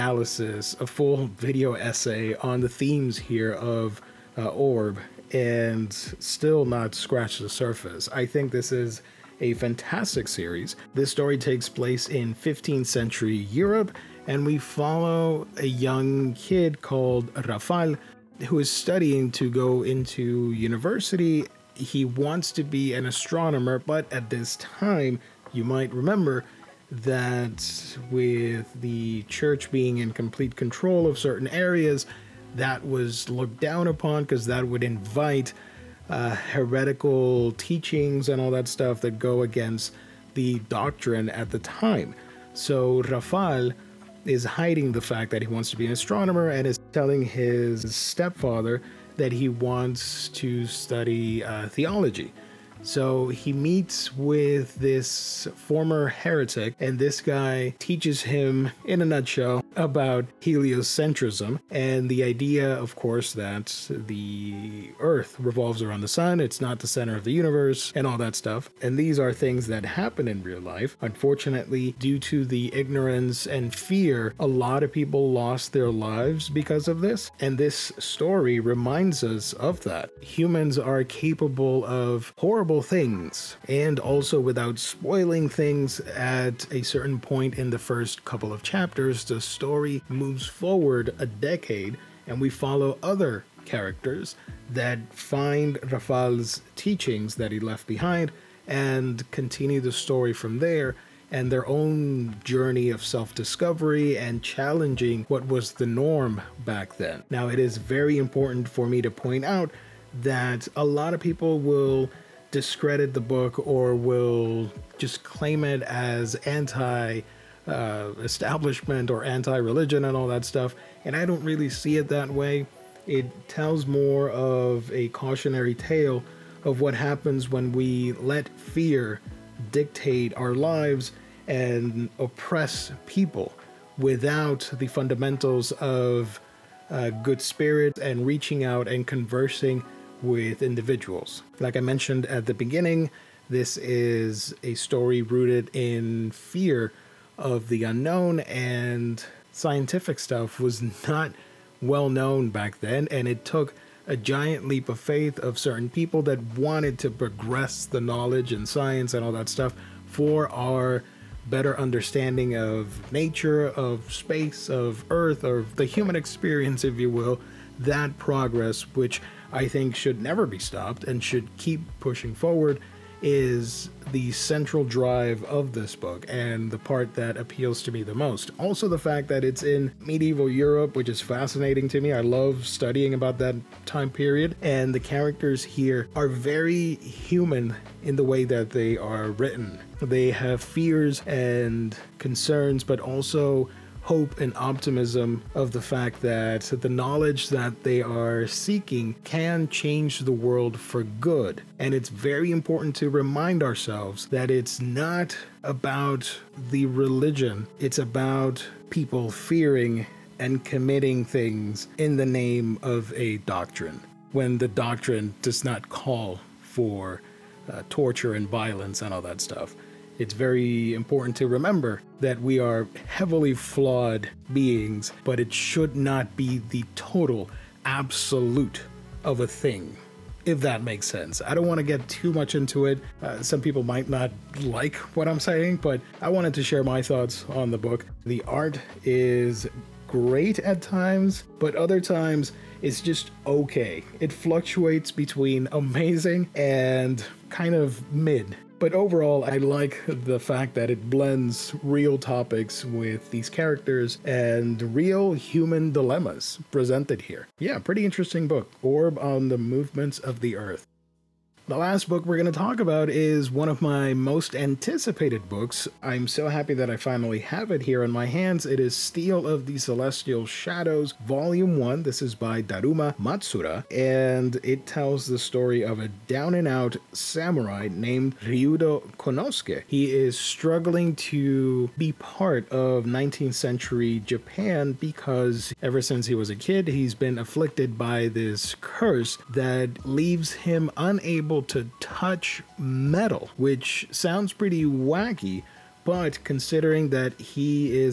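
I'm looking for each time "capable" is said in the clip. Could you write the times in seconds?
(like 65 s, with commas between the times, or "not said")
81 s.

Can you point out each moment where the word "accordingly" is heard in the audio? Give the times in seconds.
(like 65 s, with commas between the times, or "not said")
not said.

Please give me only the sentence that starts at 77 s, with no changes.
And this story reminds us of that.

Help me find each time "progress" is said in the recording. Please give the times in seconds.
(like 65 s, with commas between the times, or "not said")
157 s, 168 s.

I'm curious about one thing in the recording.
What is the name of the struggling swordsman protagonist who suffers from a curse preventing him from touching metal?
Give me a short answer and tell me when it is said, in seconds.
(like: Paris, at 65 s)
Ryudo Konosuke, at 278 s.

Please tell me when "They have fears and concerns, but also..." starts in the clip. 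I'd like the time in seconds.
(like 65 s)
190 s.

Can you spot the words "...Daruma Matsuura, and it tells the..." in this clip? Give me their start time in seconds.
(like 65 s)
272 s.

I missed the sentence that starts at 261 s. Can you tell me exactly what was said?
The last book we're going to talk about is one of my most anticipated books.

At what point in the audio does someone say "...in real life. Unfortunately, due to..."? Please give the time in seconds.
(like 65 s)
70 s.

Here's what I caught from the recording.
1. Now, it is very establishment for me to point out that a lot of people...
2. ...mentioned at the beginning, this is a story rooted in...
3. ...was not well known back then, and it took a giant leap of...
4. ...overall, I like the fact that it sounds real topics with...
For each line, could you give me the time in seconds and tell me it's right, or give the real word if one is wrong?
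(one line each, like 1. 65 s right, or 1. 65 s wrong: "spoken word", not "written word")
1. 107 s wrong: "important", not "establishment"
2. 141 s right
3. 150 s right
4. 248 s wrong: "blends", not "sounds".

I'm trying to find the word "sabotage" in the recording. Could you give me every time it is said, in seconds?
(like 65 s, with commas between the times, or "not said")
not said.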